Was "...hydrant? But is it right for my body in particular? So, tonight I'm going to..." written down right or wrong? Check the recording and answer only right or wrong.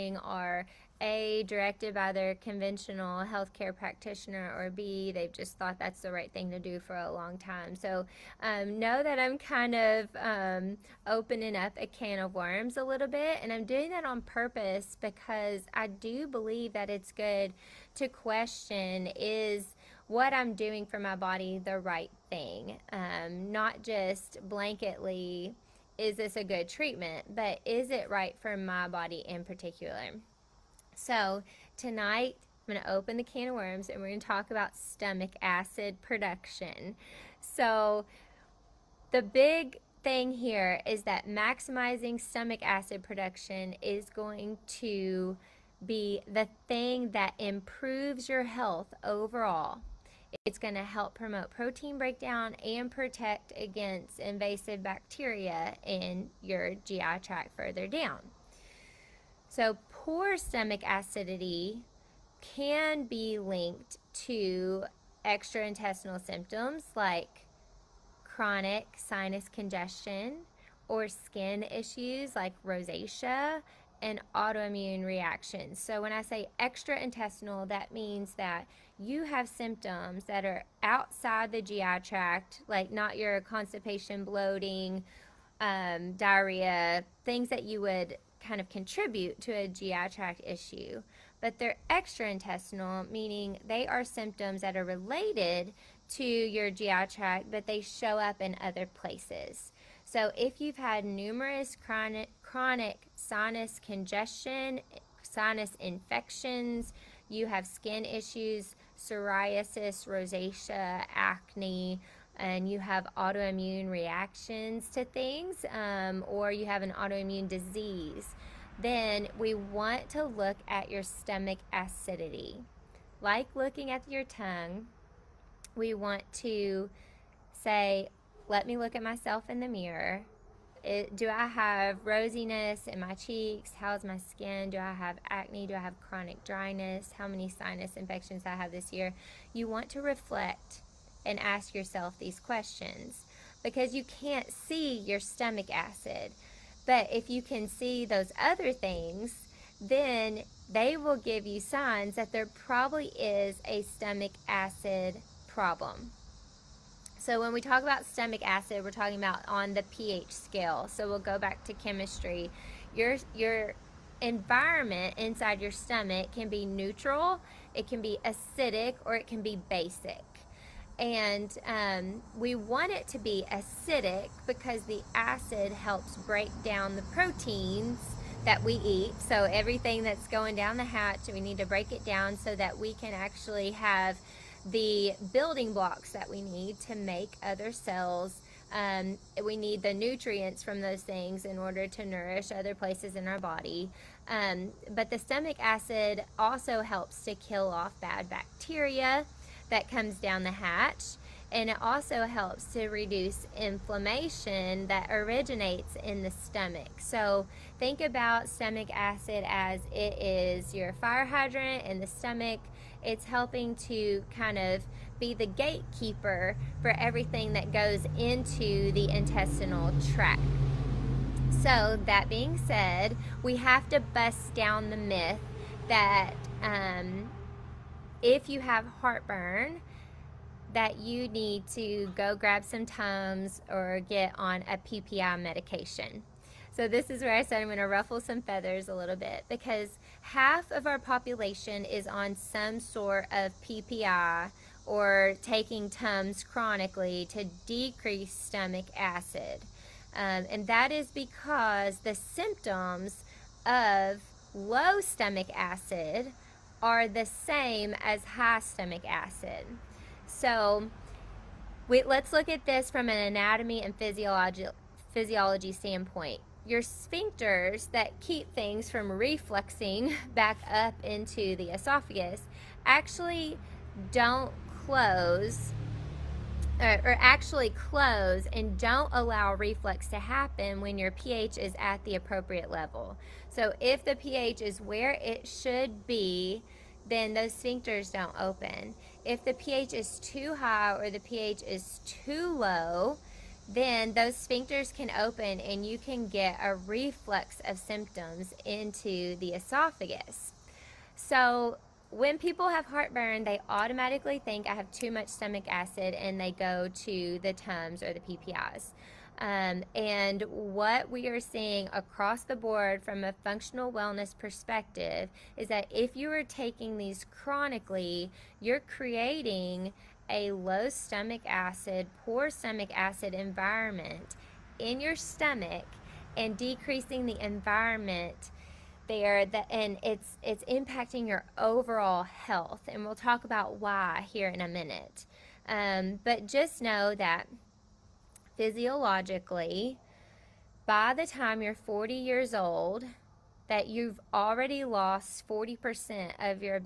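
wrong.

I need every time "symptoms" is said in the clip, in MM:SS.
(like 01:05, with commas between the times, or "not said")
01:06, 01:19, 01:34, 04:12, 04:57.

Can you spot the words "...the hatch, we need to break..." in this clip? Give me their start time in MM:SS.
03:00.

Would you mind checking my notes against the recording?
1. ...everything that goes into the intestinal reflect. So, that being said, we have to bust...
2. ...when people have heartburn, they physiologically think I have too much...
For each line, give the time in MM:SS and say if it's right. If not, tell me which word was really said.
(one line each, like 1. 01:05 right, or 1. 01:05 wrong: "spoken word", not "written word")
1. 03:36 wrong: "tract", not "reflect"
2. 05:02 wrong: "automatically", not "physiologically".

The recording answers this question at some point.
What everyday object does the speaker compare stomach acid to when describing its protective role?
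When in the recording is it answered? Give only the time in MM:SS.
03:30.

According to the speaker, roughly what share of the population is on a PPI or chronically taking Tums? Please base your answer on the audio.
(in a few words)
half.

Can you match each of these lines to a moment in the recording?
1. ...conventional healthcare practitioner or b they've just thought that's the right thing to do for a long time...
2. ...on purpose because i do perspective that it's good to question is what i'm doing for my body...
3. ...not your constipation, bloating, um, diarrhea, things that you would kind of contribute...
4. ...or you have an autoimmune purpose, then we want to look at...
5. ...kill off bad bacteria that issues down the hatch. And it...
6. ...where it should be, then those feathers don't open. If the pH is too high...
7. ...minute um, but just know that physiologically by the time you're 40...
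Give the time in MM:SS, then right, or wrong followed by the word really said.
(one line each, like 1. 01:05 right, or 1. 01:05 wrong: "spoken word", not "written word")
1. 00:02 right
2. 00:14 wrong: "believe", not "perspective"
3. 01:22 right
4. 01:56 wrong: "disease", not "purpose"
5. 03:17 wrong: "comes", not "issues"
6. 04:44 wrong: "sphincters", not "feathers"
7. 05:34 right.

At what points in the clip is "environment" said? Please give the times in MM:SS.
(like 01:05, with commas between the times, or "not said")
02:44, 05:23, 05:27.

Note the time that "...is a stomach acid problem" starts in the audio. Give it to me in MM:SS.
02:33.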